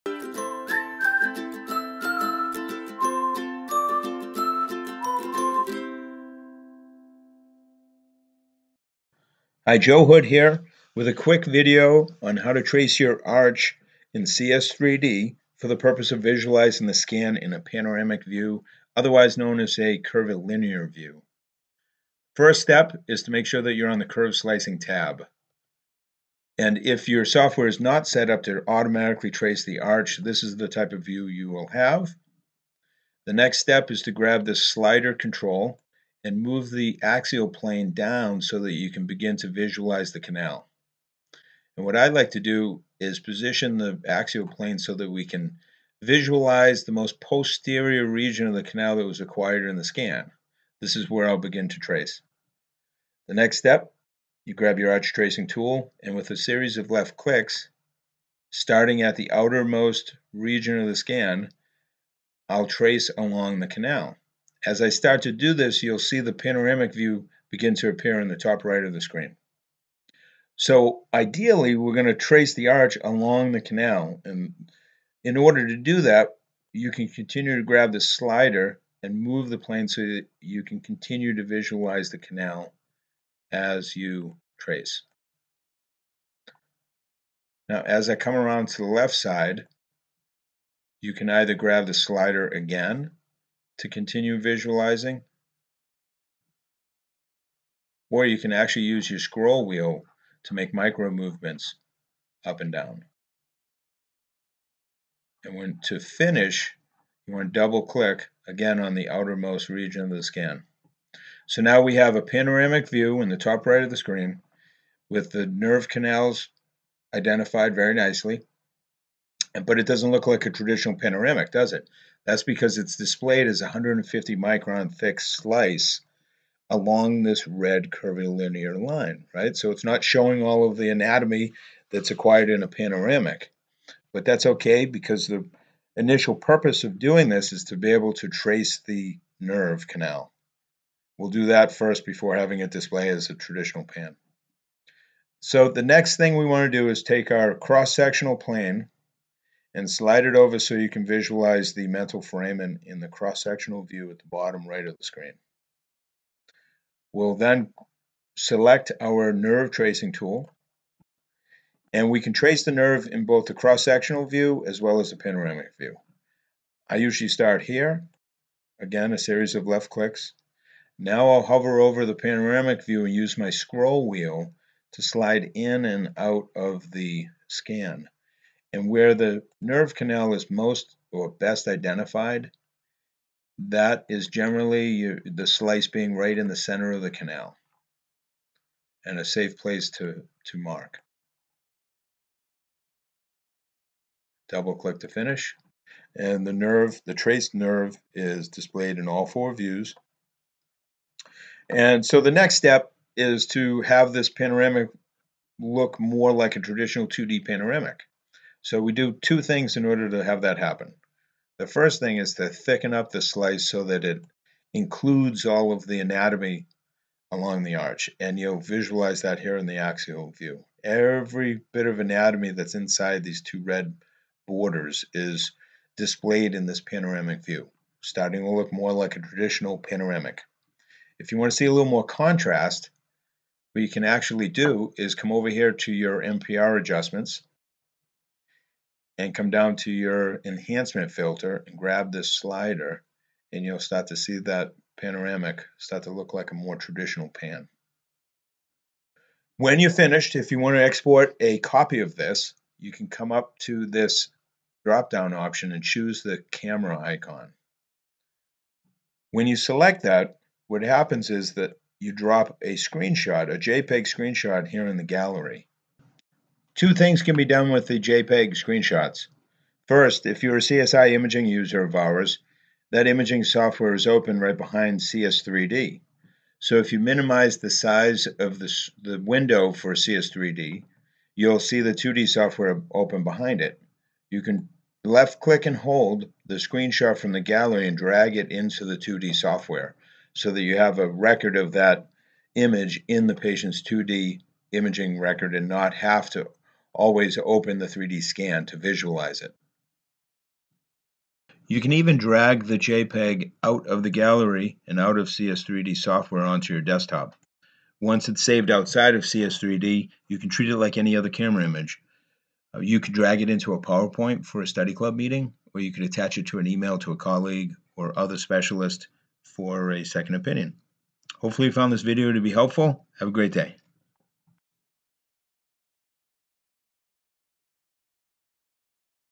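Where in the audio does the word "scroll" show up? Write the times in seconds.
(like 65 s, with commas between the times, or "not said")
99 s, 173 s.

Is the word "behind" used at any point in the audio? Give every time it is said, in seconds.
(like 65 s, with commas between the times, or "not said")
274 s, 283 s.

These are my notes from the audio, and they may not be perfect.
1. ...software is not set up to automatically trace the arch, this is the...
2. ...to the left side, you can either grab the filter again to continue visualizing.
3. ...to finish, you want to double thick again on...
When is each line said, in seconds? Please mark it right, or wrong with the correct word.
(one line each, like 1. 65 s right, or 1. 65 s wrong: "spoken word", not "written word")
1. 27 s right
2. 88 s wrong: "slider", not "filter"
3. 105 s wrong: "click", not "thick".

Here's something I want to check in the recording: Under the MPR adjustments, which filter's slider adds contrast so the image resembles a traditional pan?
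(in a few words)
Enhancement filter.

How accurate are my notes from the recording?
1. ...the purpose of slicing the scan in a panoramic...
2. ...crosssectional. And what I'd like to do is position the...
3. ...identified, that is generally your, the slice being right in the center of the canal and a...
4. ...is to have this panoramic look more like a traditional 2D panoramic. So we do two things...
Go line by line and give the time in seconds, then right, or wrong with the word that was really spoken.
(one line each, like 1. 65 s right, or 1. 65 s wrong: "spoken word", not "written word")
1. 15 s wrong: "visualizing", not "slicing"
2. 40 s wrong: "canal", not "crosssectional"
3. 181 s right
4. 203 s right.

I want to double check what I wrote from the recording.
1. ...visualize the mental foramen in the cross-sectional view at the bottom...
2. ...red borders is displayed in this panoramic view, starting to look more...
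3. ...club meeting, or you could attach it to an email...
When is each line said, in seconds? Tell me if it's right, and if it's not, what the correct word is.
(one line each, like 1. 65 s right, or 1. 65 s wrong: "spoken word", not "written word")
1. 151 s right
2. 223 s right
3. 314 s right.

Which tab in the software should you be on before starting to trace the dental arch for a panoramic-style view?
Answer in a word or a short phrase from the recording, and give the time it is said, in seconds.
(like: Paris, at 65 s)
Curve slicing tab, at 24 s.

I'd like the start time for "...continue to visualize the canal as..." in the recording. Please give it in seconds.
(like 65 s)
80 s.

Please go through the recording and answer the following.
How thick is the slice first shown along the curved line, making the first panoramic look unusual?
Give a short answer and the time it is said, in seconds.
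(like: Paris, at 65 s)
150 micron, at 123 s.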